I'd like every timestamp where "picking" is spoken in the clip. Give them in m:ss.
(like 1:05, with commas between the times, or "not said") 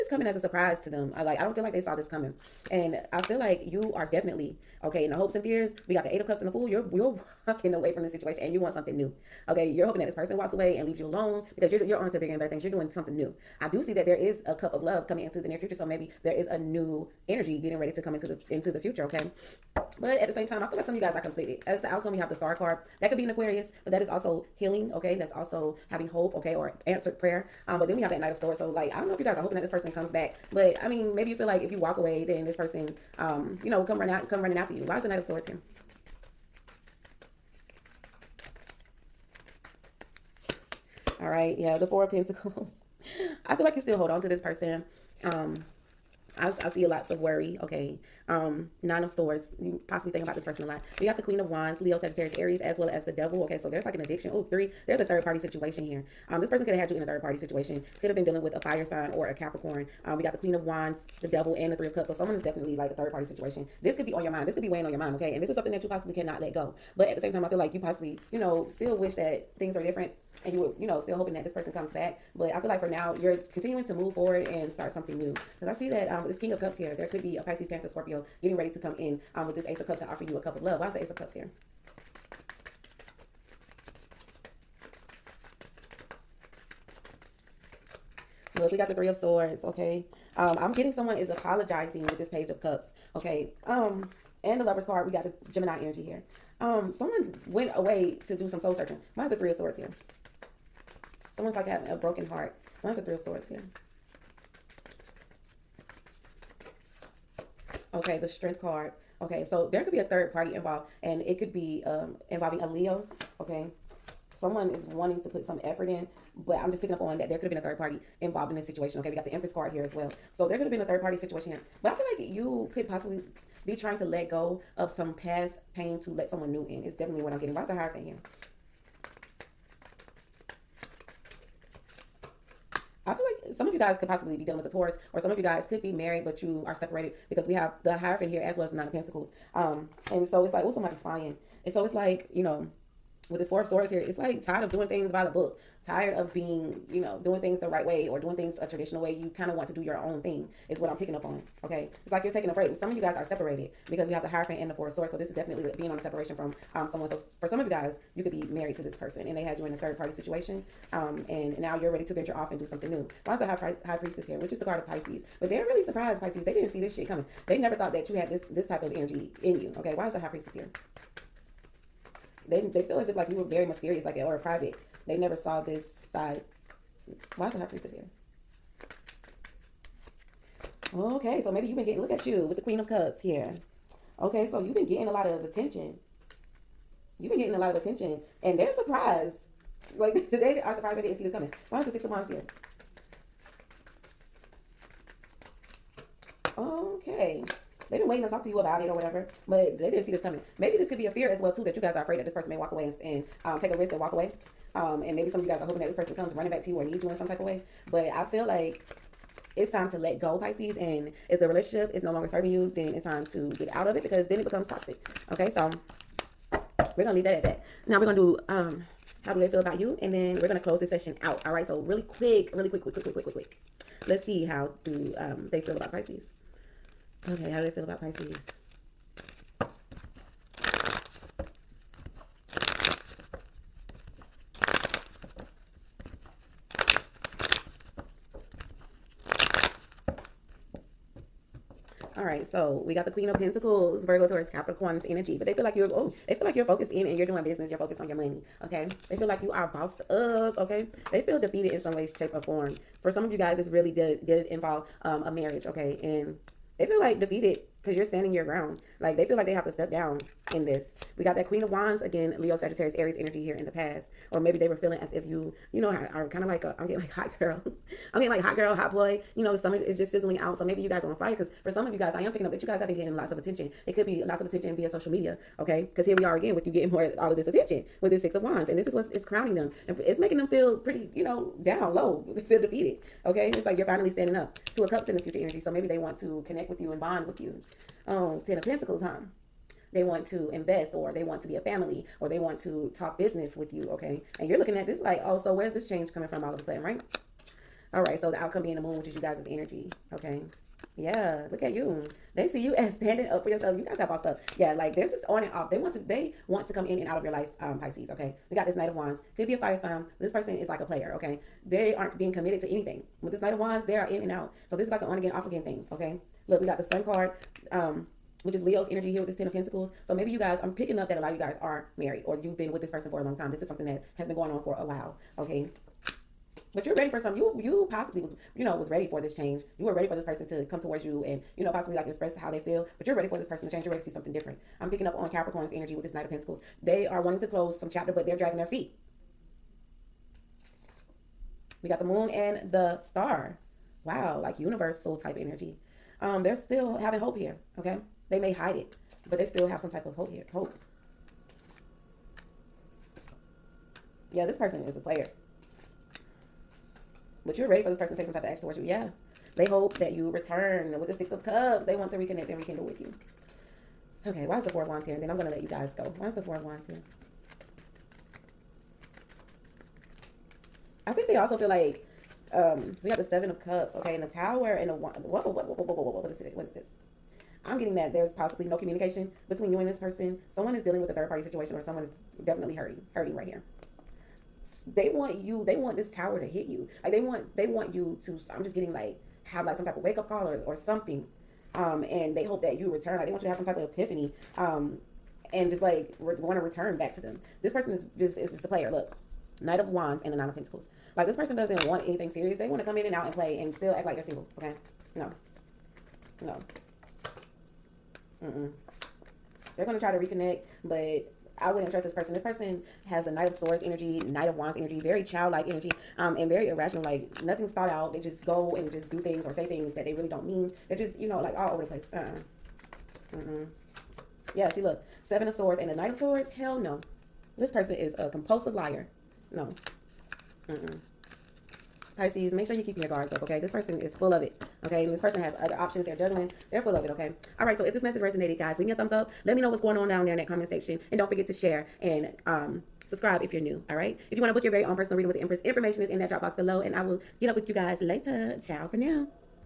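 1:56, 2:30, 4:32, 5:20, 5:34.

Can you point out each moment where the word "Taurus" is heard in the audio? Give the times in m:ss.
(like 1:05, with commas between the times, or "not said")
2:14, 4:04.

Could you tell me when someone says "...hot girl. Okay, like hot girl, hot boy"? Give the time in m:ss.
4:27.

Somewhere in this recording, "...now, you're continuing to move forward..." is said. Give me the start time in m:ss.
1:12.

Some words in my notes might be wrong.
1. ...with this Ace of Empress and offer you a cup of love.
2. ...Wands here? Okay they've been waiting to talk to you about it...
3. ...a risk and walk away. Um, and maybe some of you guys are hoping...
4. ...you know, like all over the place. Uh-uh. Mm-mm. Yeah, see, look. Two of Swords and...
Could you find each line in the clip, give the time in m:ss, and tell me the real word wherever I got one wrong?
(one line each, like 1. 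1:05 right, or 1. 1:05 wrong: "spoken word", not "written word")
1. 1:19 wrong: "Cups", not "Empress"
2. 3:12 right
3. 3:23 right
4. 7:01 wrong: "Seven", not "Two".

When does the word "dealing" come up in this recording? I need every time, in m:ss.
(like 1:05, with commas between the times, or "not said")
0:58, 2:14, 6:20.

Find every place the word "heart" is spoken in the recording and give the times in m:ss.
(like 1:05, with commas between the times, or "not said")
1:42.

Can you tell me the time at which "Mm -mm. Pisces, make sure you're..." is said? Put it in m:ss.
7:10.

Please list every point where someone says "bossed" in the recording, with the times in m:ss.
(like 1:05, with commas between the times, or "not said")
4:09, 5:04.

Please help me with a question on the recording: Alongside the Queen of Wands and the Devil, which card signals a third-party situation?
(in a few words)
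Three of Cups.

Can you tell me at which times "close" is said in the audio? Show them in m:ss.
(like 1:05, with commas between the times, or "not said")
3:40, 5:37.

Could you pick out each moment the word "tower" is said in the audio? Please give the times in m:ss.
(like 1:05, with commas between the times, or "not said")
6:14, 6:26.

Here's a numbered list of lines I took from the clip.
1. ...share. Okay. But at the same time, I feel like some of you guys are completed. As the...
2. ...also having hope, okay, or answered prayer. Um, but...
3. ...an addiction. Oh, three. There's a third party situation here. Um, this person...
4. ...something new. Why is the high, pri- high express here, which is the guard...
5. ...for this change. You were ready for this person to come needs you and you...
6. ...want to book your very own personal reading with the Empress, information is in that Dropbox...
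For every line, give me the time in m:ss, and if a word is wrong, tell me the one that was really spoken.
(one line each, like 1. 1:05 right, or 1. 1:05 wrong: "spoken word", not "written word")
1. 0:18 wrong: "future", not "share"
2. 0:25 right
3. 0:53 right
4. 2:42 wrong: "priestess", not "express"
5. 5:29 wrong: "towards", not "needs"
6. 7:24 right.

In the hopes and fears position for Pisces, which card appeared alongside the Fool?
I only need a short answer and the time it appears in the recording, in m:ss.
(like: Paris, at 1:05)
8 of Cups, at 0:06.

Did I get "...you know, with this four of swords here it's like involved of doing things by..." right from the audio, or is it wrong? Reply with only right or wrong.
wrong.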